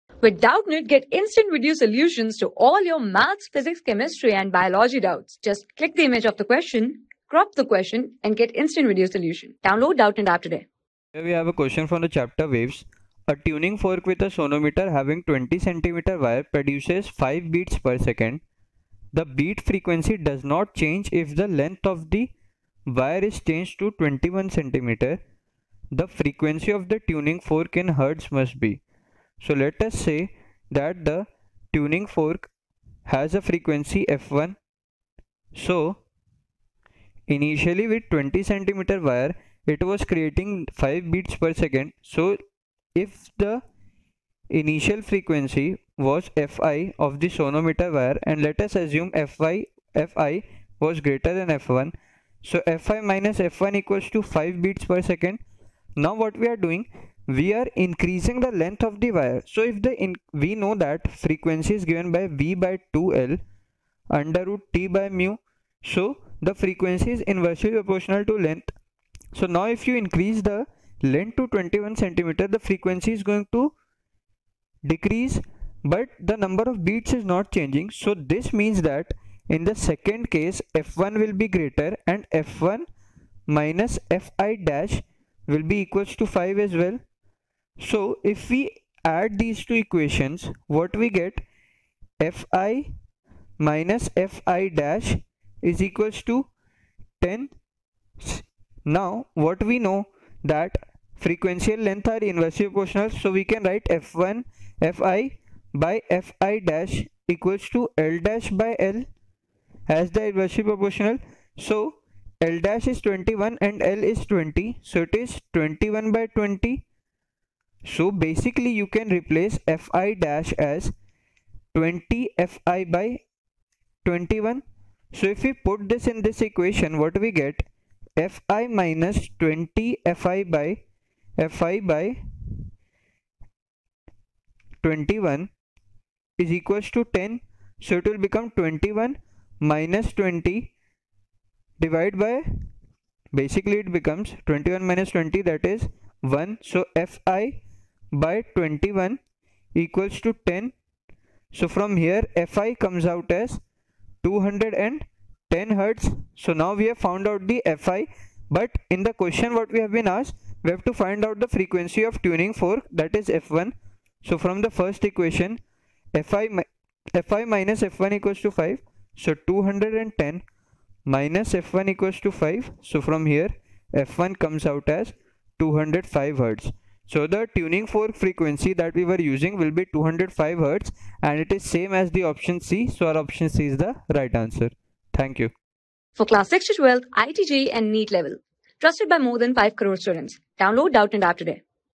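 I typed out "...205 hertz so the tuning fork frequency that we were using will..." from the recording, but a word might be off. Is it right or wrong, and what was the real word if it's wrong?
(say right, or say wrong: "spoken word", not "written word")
right.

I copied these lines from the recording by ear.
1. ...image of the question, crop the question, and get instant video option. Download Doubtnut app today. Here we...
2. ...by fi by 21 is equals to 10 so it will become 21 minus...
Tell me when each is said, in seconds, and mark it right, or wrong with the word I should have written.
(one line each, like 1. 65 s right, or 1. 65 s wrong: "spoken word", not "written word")
1. 6 s wrong: "solution", not "option"
2. 130 s right.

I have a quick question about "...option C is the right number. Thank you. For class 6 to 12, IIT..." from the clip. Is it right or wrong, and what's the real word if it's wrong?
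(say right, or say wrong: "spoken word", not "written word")
wrong: "answer", not "number".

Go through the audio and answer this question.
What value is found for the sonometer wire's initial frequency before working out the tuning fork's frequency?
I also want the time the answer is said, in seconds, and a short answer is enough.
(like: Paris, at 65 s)
210 hertz, at 154 s.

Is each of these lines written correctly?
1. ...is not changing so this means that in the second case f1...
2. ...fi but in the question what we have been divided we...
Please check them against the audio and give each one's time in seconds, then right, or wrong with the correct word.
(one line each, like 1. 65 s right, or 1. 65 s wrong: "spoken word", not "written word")
1. 77 s right
2. 157 s wrong: "asked", not "divided".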